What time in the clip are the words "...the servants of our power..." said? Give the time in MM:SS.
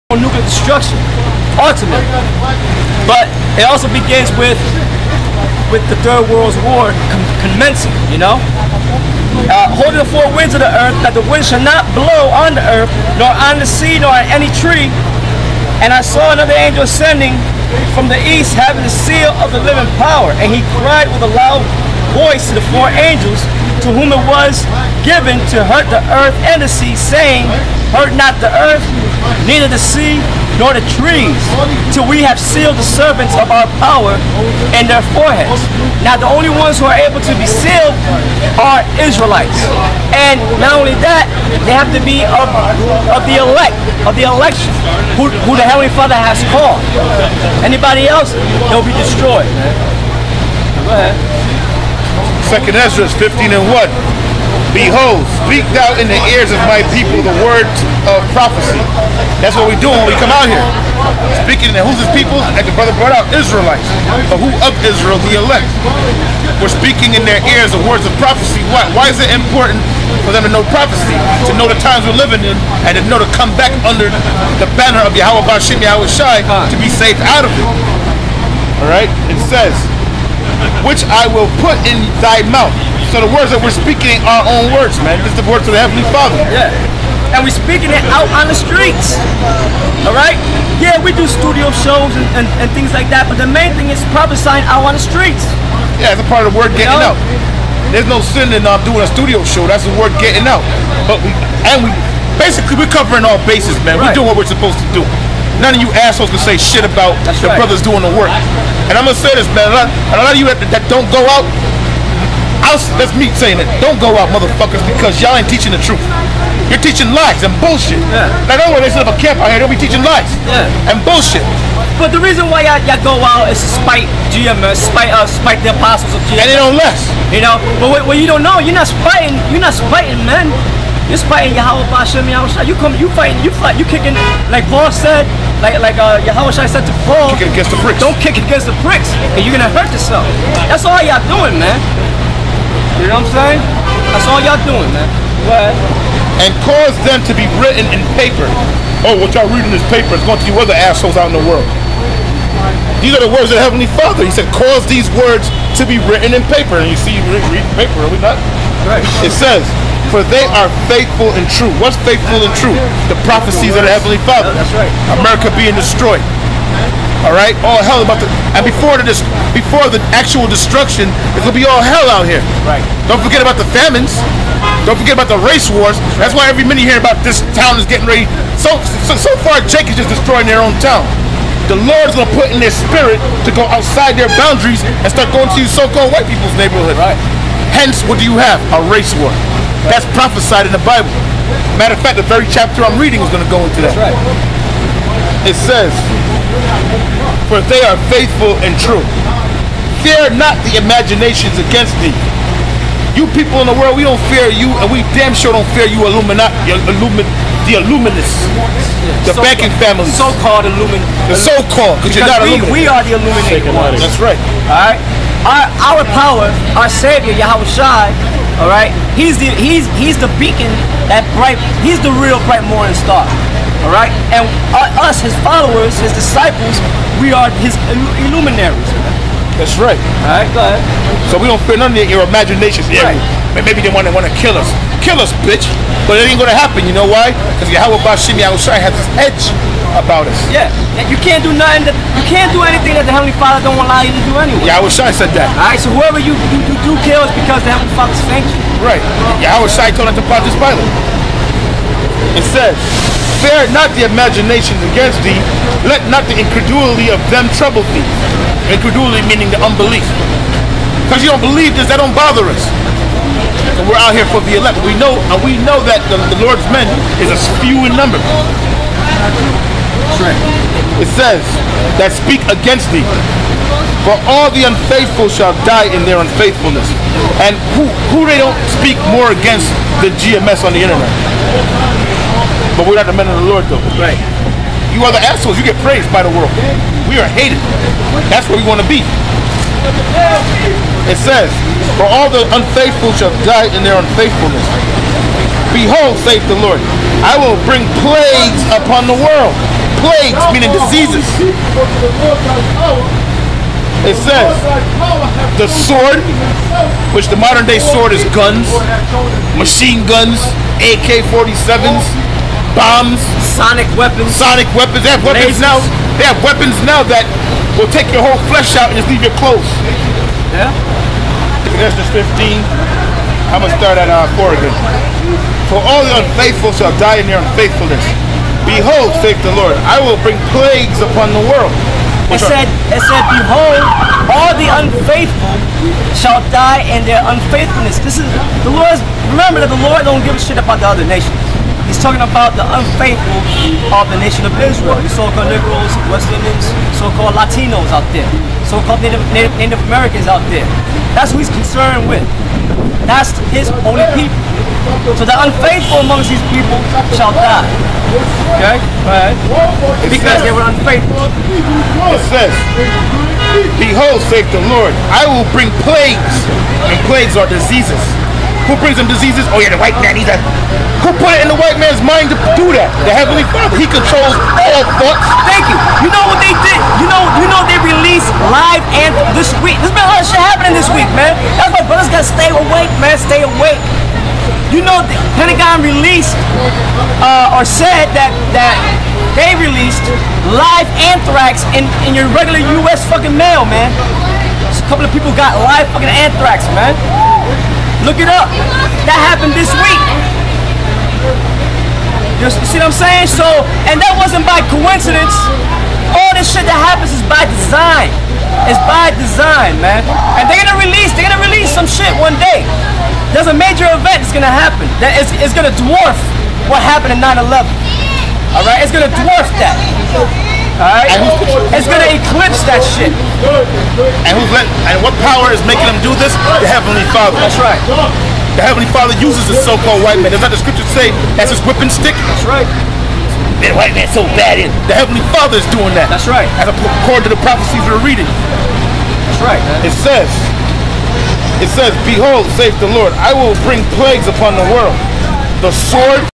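00:32.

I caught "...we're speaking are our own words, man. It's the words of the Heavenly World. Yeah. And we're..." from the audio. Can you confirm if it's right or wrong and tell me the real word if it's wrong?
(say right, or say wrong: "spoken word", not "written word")
wrong: "Father", not "World".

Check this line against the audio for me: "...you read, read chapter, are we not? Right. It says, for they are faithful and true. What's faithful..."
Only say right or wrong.
wrong.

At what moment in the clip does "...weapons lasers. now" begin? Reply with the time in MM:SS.
05:15.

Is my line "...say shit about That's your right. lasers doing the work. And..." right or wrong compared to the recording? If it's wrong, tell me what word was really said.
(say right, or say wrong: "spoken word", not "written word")
wrong: "brothers", not "lasers".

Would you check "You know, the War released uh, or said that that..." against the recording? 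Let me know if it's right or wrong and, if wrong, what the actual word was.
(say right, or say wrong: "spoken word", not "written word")
wrong: "Pentagon", not "War".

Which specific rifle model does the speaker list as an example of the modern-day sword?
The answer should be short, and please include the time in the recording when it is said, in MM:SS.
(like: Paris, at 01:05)
AK-47s, at 05:10.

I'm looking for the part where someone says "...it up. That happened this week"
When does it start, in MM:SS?
06:38.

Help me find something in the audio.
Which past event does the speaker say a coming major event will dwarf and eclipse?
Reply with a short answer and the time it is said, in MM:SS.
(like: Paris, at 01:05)
9-11, at 06:57.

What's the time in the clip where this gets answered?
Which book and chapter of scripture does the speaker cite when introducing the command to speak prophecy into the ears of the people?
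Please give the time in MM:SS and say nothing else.
00:52.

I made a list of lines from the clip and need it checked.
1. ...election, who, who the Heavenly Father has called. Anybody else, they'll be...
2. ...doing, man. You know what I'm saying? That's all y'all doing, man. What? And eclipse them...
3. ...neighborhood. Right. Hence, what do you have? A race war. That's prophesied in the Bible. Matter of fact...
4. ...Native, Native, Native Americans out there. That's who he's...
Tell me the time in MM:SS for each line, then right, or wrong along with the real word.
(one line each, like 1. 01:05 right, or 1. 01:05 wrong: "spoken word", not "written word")
1. 00:44 right
2. 02:21 wrong: "cause", not "eclipse"
3. 03:06 right
4. 05:49 right.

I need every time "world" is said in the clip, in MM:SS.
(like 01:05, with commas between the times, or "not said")
00:06, 02:31, 03:23, 04:46, 04:59, 05:31, 07:24.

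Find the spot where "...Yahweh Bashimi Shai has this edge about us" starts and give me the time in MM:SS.
03:57.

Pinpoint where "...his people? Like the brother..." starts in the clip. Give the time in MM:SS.
01:01.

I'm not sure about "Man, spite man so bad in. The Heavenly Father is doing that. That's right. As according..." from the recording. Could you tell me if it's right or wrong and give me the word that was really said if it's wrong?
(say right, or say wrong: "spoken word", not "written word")
wrong: "white", not "spite".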